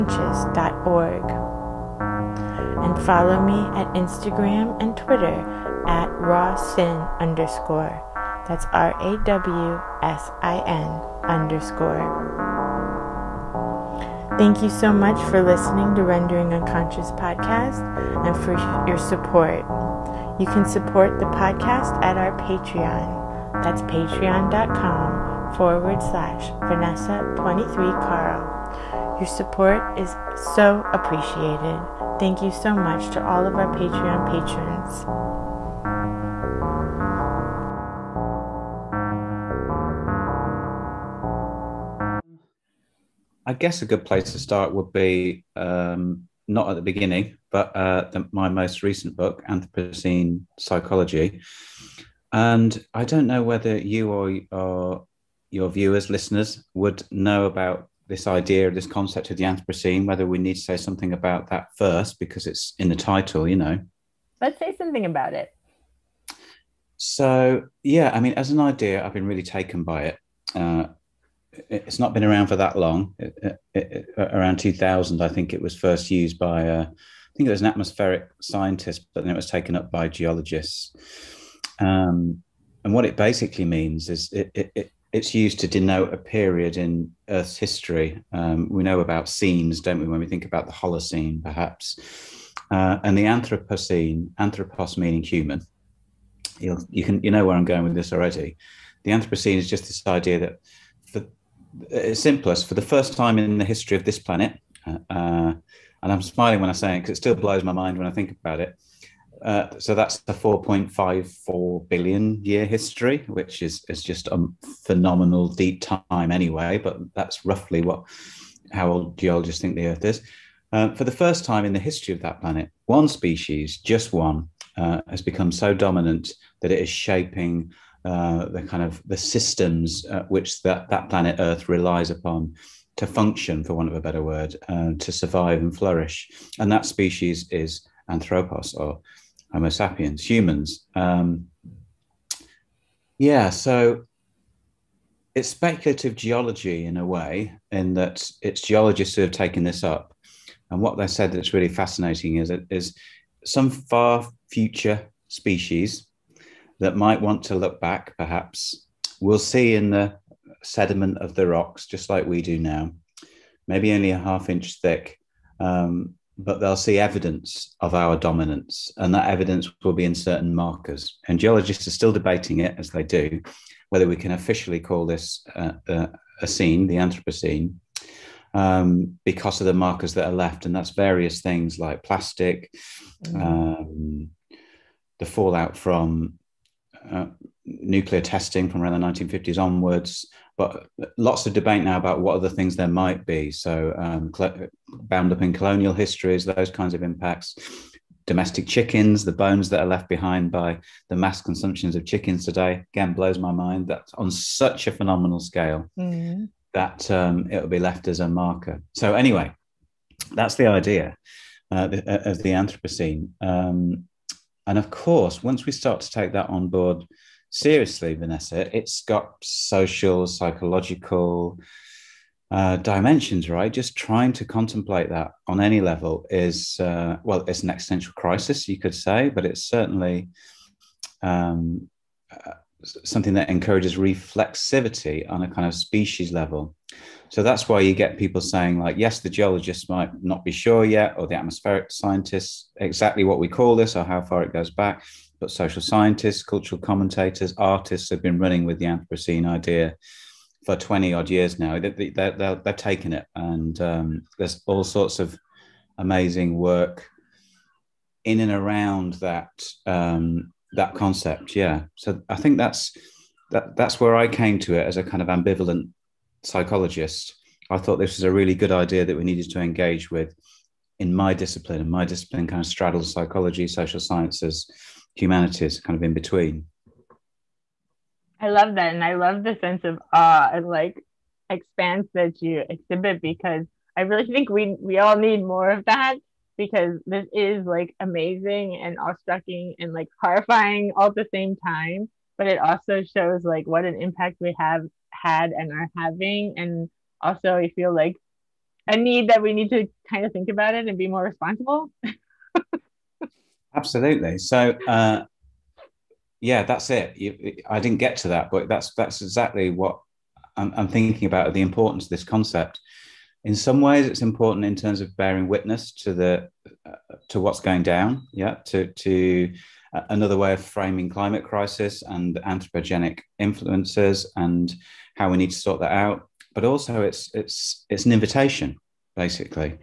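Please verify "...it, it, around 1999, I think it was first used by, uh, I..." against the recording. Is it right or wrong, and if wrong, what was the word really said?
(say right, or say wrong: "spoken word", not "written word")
wrong: "2000", not "1999".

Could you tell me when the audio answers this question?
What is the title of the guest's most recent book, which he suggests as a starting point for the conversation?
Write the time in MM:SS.
00:49.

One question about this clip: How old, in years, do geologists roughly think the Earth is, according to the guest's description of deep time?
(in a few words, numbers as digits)
4.54 billion years.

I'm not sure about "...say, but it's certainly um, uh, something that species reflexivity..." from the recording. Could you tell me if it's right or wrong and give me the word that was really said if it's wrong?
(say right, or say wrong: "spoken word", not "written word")
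wrong: "encourages", not "species".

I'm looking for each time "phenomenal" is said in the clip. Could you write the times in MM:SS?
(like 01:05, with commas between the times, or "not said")
01:54, 03:24.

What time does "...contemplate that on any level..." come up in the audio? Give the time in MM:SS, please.
03:44.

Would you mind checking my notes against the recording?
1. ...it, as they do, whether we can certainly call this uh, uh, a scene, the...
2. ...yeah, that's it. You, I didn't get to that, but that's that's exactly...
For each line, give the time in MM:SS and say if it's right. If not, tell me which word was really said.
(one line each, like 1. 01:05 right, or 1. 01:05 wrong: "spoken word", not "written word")
1. 02:52 wrong: "officially", not "certainly"
2. 05:06 right.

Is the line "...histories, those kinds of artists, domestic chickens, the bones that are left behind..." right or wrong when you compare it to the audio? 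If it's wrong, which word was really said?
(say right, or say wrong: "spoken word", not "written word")
wrong: "impacts", not "artists".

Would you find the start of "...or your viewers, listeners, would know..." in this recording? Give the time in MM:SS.
00:54.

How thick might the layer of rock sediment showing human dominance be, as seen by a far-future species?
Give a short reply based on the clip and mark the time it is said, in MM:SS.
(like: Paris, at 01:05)
half inch, at 02:44.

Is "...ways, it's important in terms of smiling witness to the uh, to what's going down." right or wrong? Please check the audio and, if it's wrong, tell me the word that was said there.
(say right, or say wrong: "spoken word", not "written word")
wrong: "bearing", not "smiling".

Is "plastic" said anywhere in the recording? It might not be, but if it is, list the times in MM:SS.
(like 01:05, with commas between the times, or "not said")
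03:02.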